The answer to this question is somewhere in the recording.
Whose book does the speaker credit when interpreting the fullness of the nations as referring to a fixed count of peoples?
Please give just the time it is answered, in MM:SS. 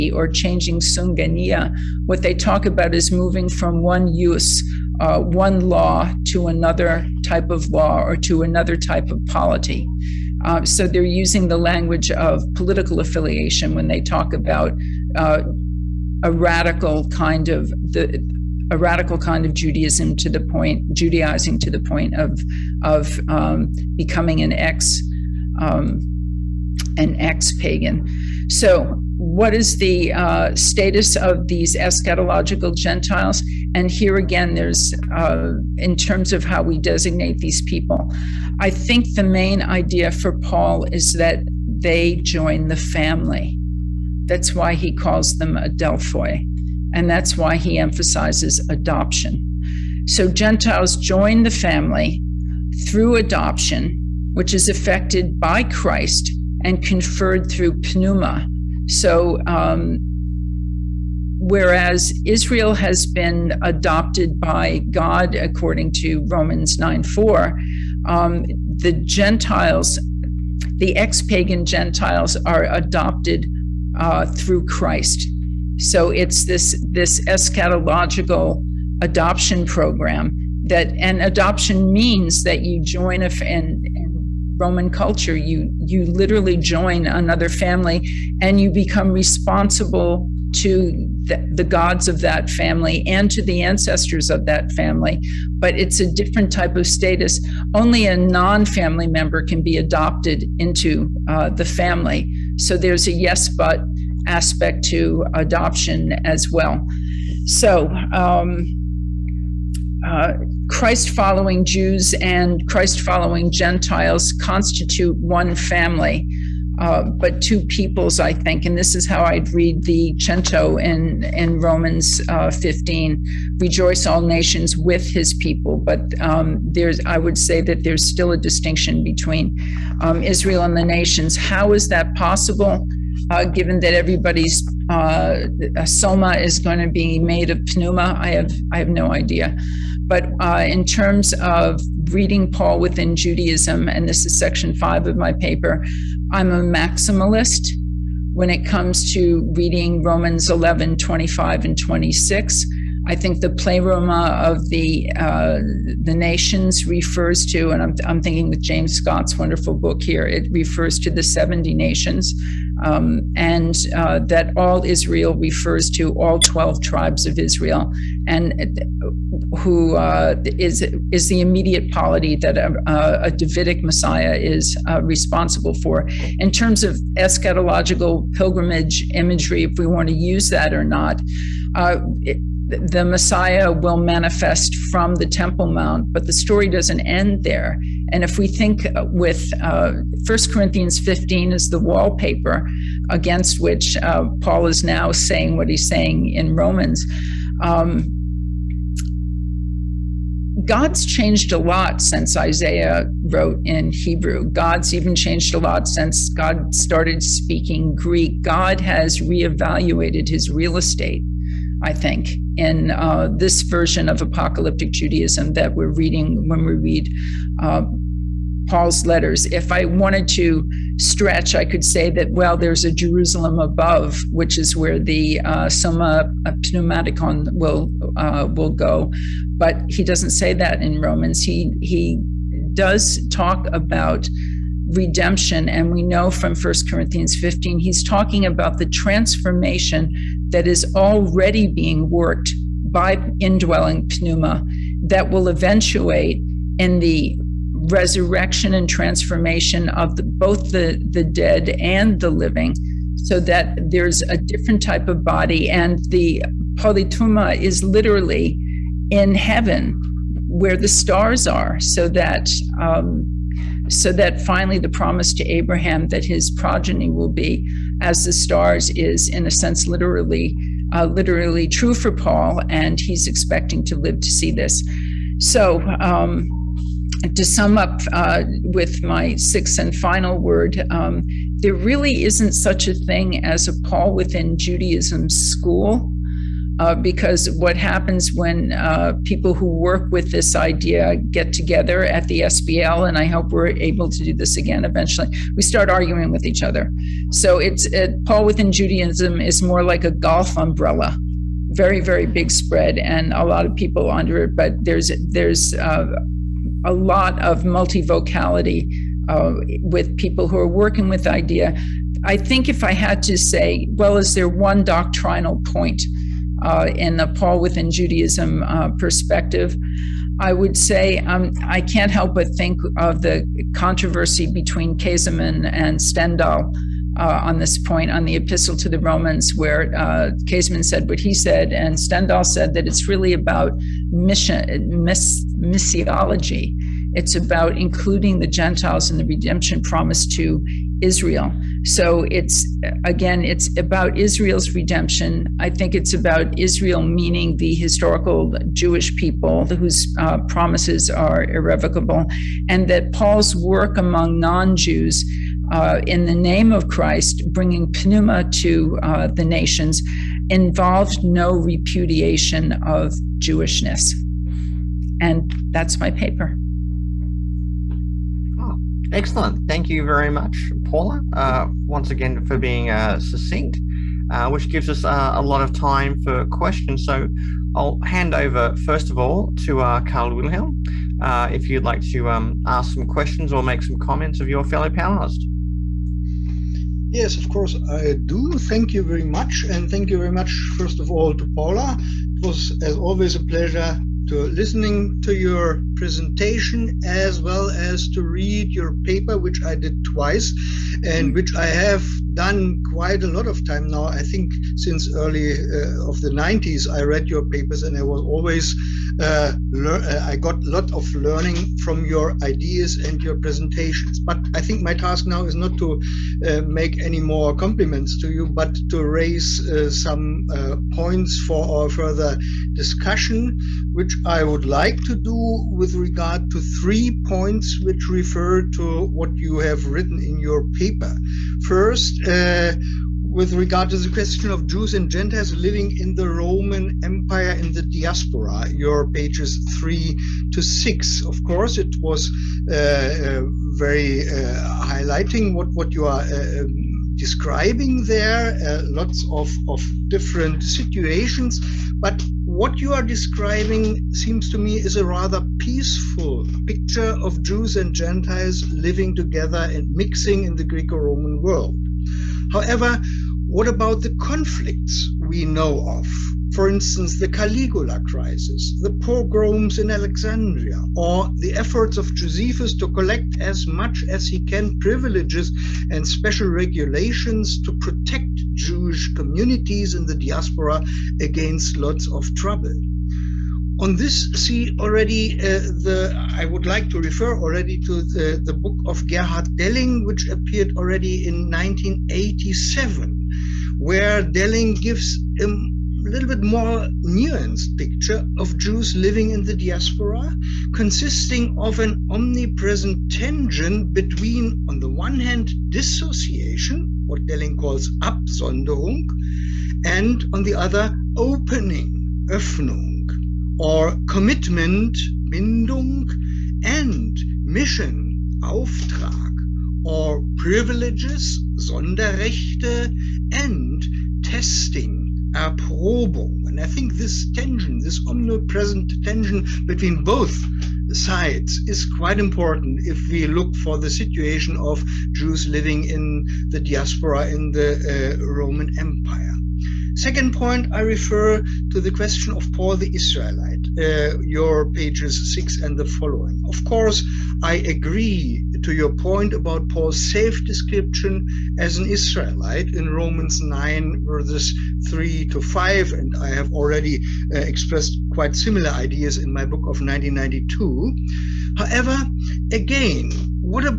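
02:38.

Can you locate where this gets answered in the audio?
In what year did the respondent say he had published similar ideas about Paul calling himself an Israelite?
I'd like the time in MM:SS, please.
09:19.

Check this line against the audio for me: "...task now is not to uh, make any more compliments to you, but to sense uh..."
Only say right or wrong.
wrong.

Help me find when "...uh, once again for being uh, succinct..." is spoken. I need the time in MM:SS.
06:11.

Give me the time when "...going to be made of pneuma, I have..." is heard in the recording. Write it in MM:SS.
02:16.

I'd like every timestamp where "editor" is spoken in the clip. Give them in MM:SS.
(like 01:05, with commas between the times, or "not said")
not said.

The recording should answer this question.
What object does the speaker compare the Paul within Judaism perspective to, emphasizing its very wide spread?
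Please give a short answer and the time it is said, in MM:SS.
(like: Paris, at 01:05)
golf umbrella, at 05:00.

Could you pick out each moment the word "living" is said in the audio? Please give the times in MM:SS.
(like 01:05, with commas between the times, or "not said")
04:12, 07:15, 07:38, 08:18, 08:55.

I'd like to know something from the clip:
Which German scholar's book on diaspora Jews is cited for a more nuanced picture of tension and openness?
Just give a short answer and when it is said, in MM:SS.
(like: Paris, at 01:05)
Gerhard Delling, at 08:09.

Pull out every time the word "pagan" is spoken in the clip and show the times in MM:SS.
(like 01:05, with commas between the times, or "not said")
00:27, 01:11.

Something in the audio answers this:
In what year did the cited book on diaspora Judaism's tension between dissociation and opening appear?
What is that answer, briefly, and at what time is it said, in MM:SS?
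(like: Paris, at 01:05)
1987, at 08:11.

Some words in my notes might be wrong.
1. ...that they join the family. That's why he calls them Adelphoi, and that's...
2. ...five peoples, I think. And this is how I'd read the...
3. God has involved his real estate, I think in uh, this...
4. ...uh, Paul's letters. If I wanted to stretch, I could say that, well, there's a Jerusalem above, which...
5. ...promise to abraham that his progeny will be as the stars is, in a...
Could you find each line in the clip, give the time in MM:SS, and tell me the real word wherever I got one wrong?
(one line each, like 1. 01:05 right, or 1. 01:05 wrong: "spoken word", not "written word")
1. 00:41 right
2. 01:57 wrong: "two", not "five"
3. 03:28 wrong: "reevaluated", not "involved"
4. 03:37 right
5. 04:24 right.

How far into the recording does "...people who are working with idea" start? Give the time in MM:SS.
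05:10.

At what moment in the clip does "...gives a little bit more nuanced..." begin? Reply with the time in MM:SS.
08:14.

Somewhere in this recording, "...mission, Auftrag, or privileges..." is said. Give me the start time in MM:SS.
08:37.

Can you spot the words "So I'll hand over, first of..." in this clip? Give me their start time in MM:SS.
06:17.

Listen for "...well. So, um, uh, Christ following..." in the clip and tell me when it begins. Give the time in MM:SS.
01:46.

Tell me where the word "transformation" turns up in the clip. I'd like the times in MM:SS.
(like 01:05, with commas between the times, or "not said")
03:58, 04:08.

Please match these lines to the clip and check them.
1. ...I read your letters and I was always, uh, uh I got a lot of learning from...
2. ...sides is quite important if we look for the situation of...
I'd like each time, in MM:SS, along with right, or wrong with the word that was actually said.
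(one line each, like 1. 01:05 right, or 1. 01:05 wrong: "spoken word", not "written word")
1. 06:46 wrong: "papers", not "letters"
2. 08:50 right.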